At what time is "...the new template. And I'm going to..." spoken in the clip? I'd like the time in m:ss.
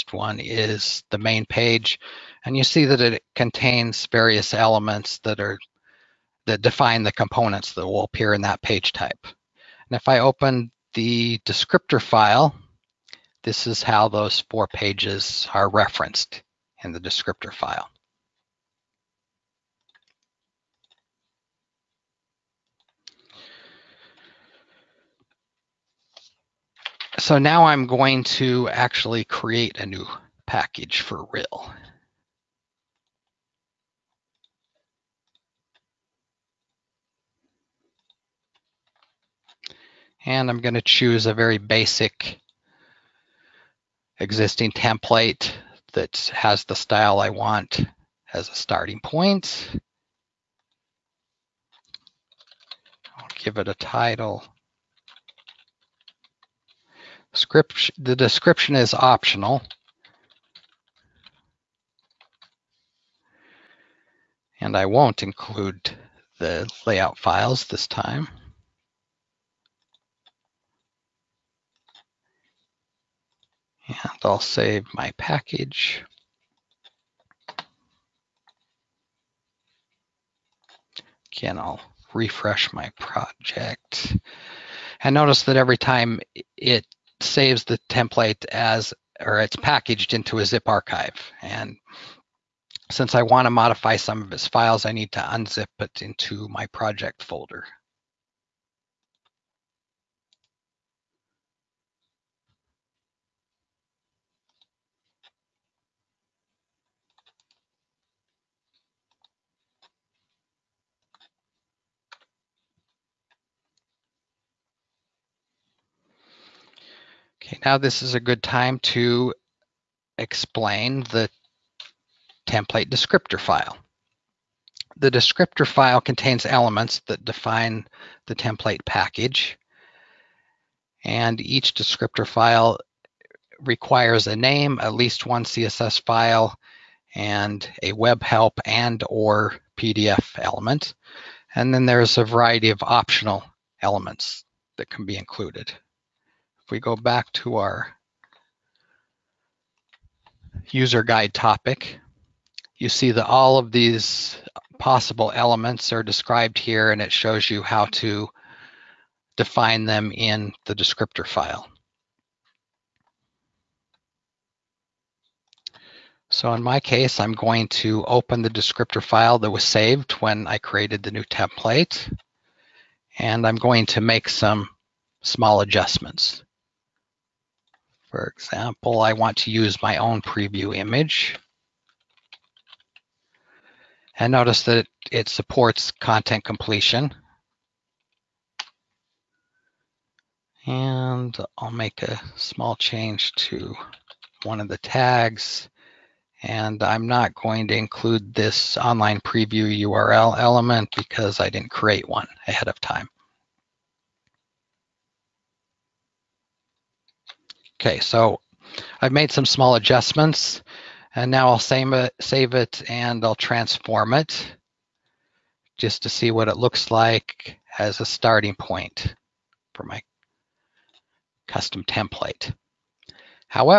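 2:51.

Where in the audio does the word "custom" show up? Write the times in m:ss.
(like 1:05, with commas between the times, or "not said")
3:41.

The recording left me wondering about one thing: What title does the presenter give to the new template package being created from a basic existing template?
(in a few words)
Script.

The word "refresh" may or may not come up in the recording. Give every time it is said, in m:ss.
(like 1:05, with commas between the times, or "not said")
1:22.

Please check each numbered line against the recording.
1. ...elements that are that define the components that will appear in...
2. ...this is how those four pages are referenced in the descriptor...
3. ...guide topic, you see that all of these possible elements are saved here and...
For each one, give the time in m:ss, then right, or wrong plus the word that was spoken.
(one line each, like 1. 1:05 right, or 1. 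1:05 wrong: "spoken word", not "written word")
1. 0:04 right
2. 0:13 right
3. 2:31 wrong: "described", not "saved".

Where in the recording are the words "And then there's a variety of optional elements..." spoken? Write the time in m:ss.
2:21.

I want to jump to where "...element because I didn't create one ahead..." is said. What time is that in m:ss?
3:20.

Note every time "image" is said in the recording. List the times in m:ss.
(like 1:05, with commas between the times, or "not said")
3:00.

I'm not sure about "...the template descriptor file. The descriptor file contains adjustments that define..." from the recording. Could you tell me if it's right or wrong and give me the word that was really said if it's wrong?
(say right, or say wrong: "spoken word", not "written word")
wrong: "elements", not "adjustments".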